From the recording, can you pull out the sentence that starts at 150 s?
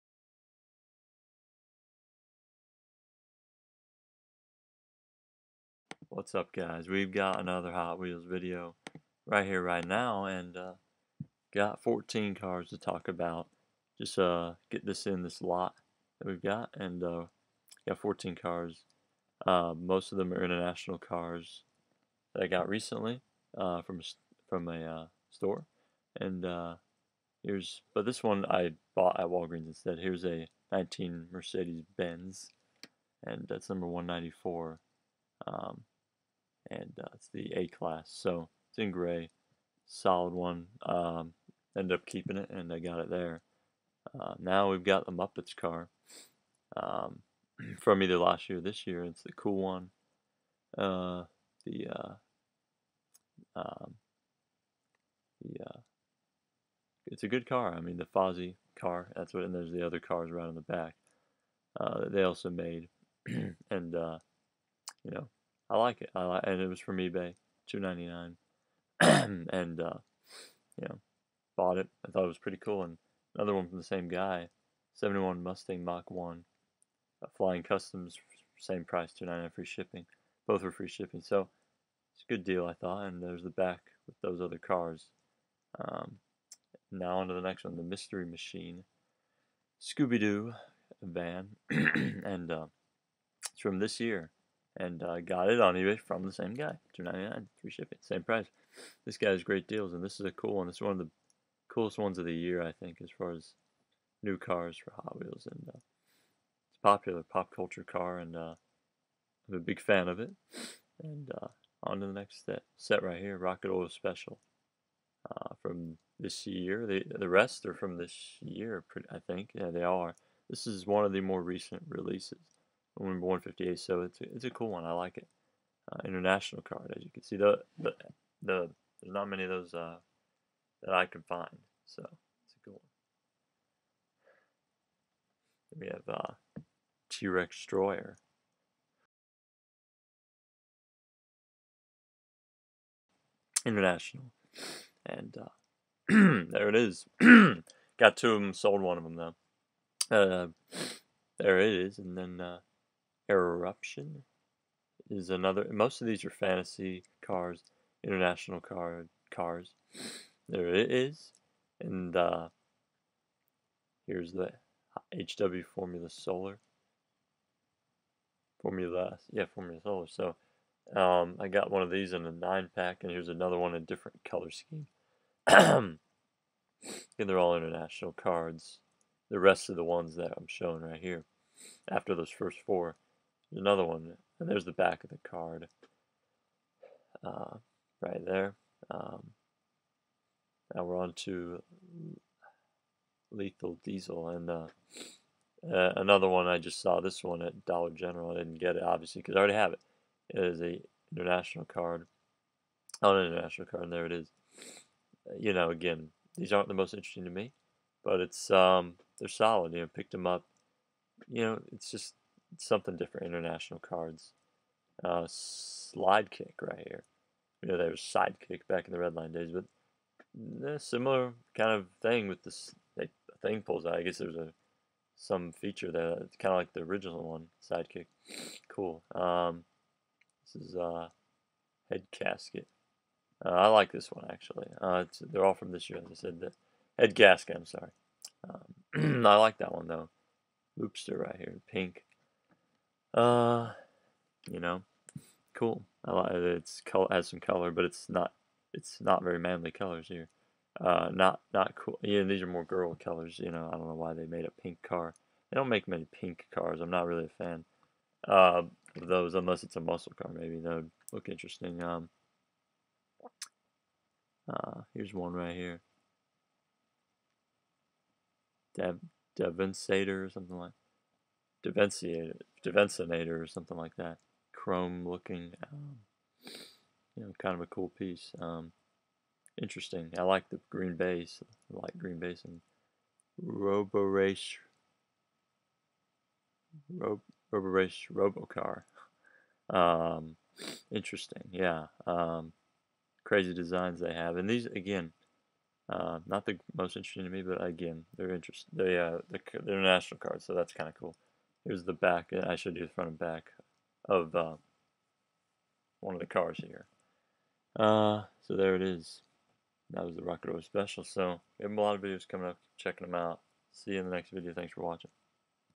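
Uh, there it is, and then uh, Eruption is another.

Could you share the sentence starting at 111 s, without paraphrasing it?
And uh, on to the next set, set right here, Rocket Oil Special, uh, from this year.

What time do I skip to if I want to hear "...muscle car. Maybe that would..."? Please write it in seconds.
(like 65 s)
259 s.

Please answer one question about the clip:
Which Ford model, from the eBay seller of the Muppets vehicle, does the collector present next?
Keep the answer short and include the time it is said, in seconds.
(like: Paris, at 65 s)
71 Mustang Mach 1, at 74 s.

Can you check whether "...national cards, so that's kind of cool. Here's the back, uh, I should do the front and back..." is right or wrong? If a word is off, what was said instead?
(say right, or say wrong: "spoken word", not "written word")
right.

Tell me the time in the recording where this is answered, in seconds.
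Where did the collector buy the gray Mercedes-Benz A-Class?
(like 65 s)
29 s.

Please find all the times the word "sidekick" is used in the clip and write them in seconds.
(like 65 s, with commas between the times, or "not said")
218 s, 227 s.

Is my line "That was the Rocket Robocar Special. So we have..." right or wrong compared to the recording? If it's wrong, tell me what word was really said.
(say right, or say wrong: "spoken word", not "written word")
wrong: "Oil", not "Robocar".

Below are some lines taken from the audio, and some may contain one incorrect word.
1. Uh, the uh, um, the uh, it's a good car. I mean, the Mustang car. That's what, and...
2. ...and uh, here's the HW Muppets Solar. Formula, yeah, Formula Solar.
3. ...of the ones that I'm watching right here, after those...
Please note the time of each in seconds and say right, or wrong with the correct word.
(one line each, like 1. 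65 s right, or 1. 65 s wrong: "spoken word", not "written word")
1. 50 s wrong: "Fozzie", not "Mustang"
2. 161 s wrong: "Formula", not "Muppets"
3. 179 s wrong: "showing", not "watching".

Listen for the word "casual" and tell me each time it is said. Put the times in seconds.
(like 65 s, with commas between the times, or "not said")
not said.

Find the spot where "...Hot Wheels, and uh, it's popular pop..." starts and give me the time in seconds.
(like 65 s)
104 s.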